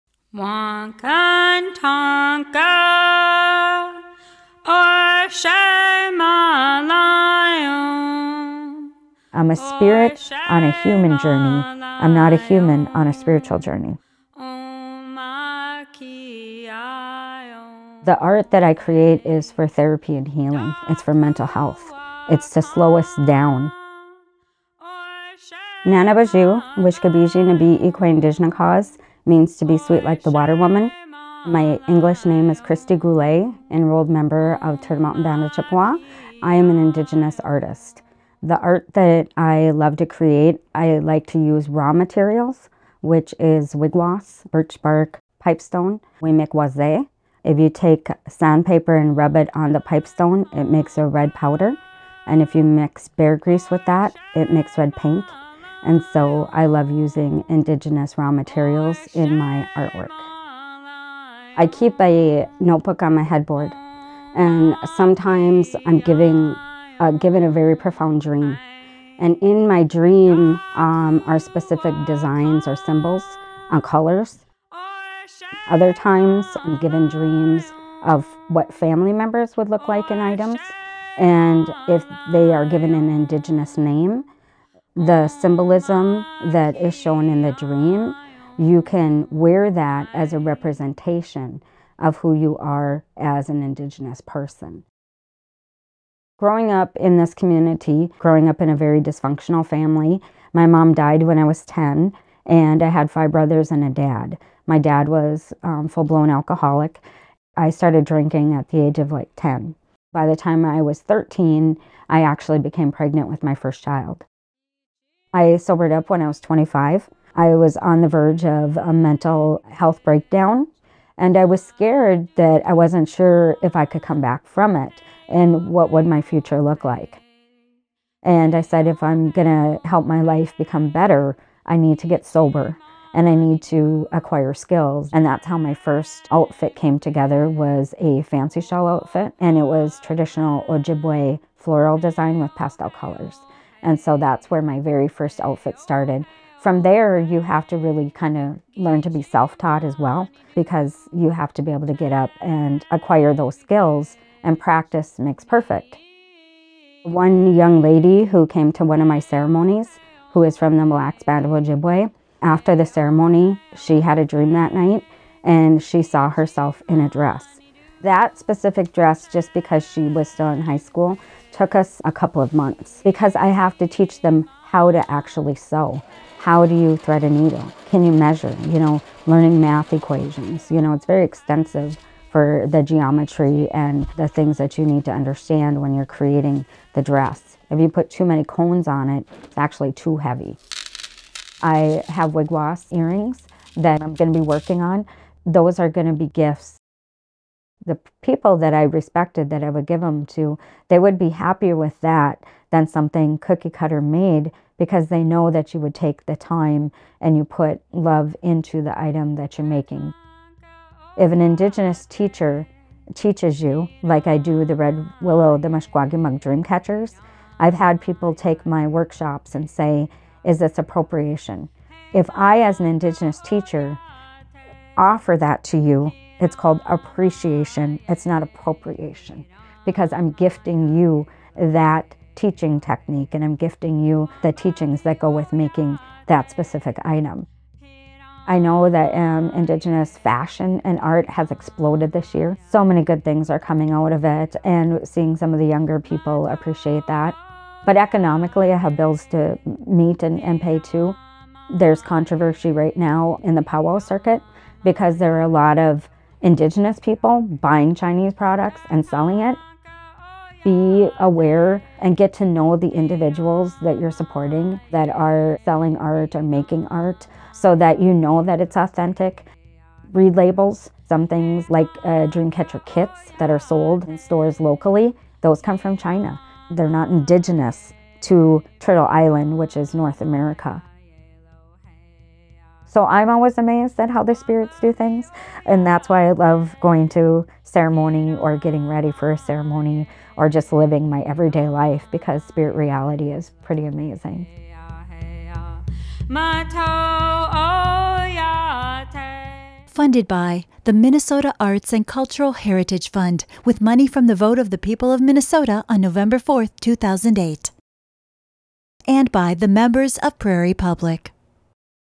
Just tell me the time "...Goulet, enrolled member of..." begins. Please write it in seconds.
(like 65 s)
32 s.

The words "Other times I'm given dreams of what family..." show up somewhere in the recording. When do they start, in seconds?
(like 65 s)
75 s.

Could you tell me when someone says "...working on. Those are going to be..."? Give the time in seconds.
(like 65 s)
194 s.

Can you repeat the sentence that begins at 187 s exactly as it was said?
If you put too many cones on it, it's actually too heavy.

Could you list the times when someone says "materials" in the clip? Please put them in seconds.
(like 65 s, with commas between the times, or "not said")
41 s, 58 s.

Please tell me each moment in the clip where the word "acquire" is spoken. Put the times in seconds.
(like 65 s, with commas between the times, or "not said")
134 s, 152 s.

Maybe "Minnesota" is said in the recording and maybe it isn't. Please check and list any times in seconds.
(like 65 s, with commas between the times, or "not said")
300 s, 305 s.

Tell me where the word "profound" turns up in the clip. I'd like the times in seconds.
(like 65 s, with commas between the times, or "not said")
67 s.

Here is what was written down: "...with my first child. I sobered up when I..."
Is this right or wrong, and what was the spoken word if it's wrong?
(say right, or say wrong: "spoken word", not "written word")
right.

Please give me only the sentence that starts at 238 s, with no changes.
I know that um, Indigenous fashion and art has exploded this year.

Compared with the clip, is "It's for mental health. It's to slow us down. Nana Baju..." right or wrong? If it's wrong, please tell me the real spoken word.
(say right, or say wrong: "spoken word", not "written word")
right.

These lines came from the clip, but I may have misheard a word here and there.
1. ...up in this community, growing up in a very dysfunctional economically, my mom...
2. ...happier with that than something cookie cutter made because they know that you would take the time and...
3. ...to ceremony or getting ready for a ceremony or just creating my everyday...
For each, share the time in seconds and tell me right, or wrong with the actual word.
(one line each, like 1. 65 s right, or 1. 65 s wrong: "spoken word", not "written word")
1. 96 s wrong: "family", not "economically"
2. 201 s right
3. 287 s wrong: "living", not "creating".